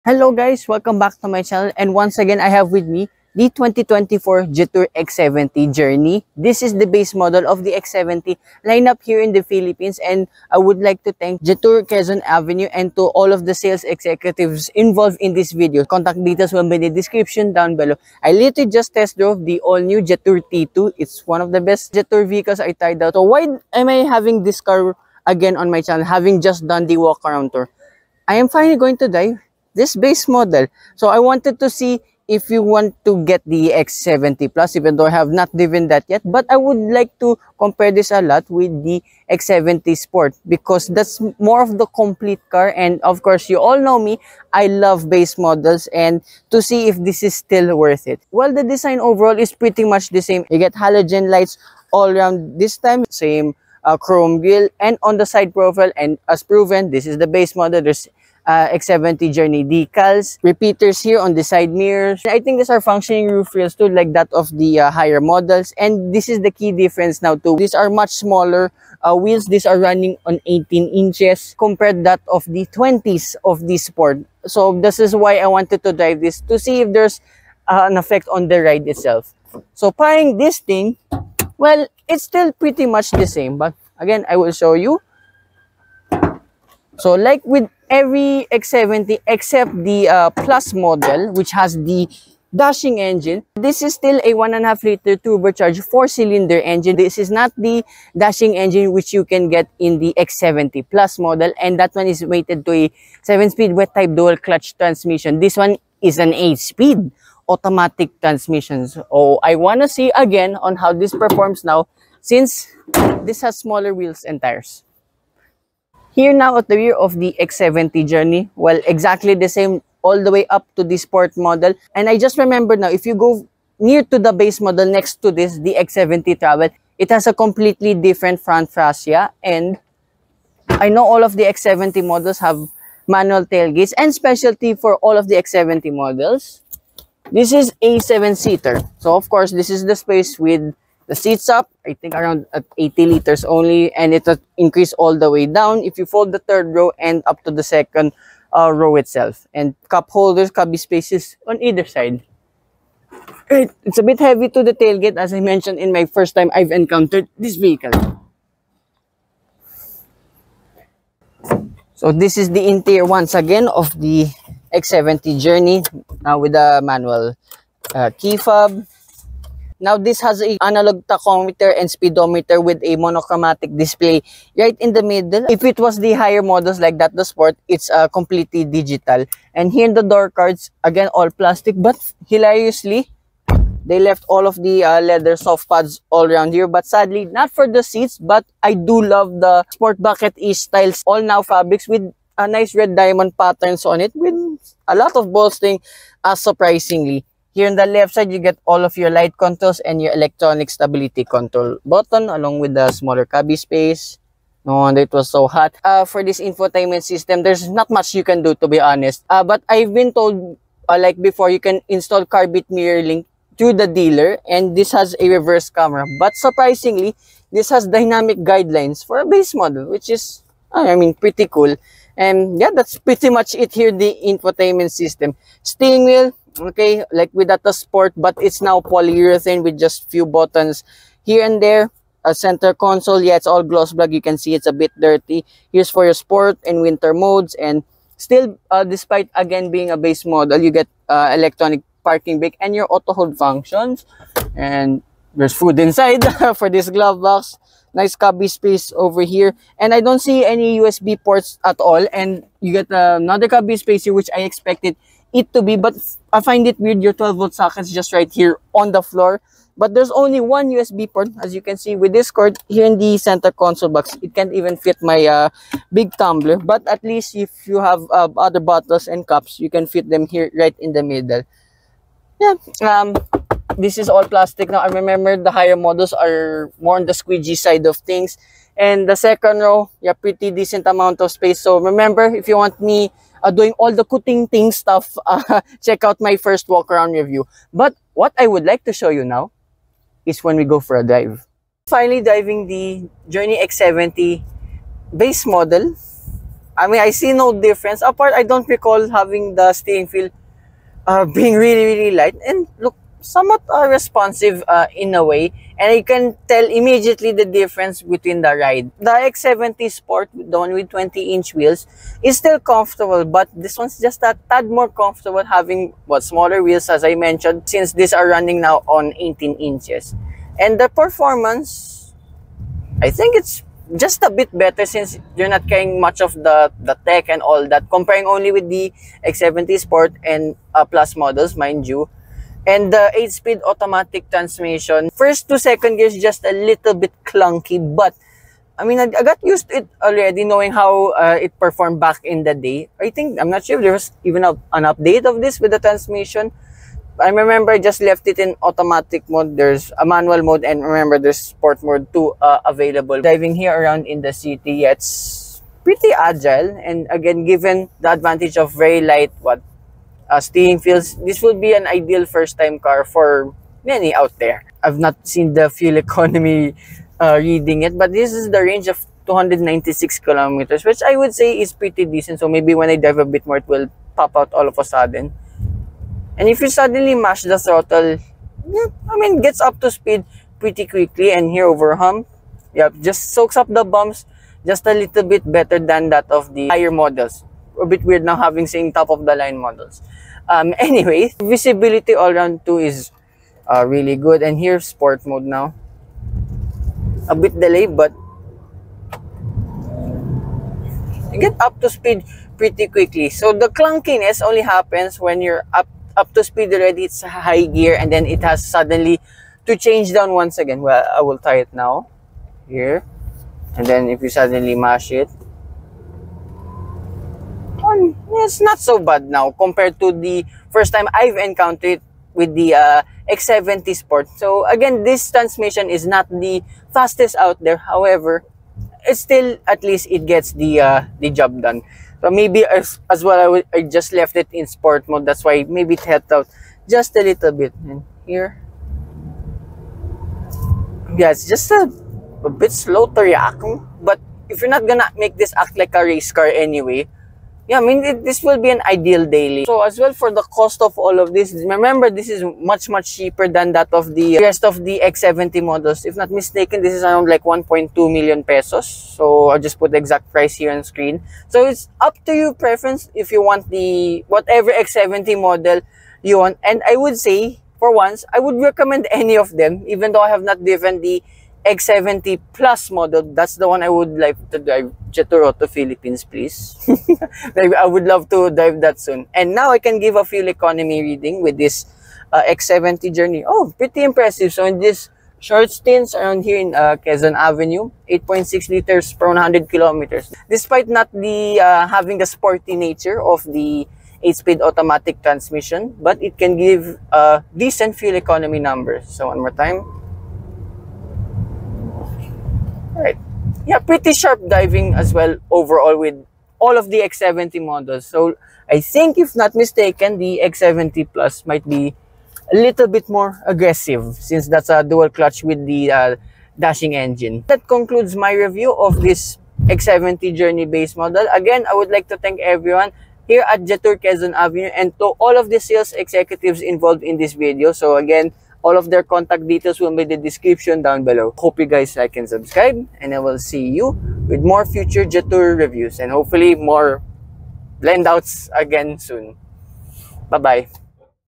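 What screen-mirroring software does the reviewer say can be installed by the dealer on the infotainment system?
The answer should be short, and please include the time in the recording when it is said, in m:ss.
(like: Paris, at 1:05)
Carbit Mirror Link, at 3:32.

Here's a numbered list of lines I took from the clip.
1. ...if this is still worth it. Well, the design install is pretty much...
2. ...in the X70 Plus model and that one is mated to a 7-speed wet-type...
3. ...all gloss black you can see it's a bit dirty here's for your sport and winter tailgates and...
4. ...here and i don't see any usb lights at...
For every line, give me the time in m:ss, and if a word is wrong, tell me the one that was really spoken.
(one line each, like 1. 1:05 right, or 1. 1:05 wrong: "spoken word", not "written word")
1. 0:46 wrong: "overall", not "install"
2. 1:39 right
3. 3:53 wrong: "modes", not "tailgates"
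4. 4:09 wrong: "ports", not "lights".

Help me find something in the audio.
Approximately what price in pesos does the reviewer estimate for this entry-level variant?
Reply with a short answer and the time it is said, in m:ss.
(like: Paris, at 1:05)
1.2 million pesos, at 7:37.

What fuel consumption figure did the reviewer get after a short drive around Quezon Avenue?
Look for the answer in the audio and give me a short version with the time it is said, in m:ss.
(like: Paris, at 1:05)
8.6 L/100 km, at 8:08.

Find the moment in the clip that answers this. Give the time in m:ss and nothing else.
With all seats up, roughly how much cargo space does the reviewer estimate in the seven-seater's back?
2:22.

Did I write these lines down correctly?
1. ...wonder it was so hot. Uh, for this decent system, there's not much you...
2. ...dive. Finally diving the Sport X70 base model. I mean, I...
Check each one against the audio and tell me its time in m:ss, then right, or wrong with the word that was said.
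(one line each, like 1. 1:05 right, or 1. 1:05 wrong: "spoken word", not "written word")
1. 3:24 wrong: "infotainment", not "decent"
2. 4:51 wrong: "Journey", not "Sport".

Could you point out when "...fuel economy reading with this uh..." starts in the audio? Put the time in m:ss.
8:00.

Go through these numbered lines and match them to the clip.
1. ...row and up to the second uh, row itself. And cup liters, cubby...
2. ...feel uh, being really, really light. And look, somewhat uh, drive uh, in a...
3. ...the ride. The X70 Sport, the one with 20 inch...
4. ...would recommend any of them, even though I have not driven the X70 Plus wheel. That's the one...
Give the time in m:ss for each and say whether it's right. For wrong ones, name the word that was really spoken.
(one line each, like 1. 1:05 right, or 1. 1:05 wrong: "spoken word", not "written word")
1. 2:26 wrong: "holders", not "liters"
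2. 5:00 wrong: "responsive", not "drive"
3. 5:08 right
4. 7:48 wrong: "model", not "wheel".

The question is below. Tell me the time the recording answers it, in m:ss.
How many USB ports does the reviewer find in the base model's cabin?
4:20.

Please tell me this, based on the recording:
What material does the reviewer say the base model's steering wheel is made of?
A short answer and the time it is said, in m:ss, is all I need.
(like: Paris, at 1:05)
Polyurethane, at 3:48.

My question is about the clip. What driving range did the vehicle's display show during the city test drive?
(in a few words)
296 kilometers.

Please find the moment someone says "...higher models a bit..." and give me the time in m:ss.
6:26.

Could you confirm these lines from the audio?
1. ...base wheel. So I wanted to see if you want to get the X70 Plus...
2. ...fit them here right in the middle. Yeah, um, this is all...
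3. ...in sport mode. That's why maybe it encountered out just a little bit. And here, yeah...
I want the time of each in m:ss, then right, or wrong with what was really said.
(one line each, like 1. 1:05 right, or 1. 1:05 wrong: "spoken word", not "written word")
1. 0:29 wrong: "model", not "wheel"
2. 4:29 right
3. 7:14 wrong: "helped", not "encountered".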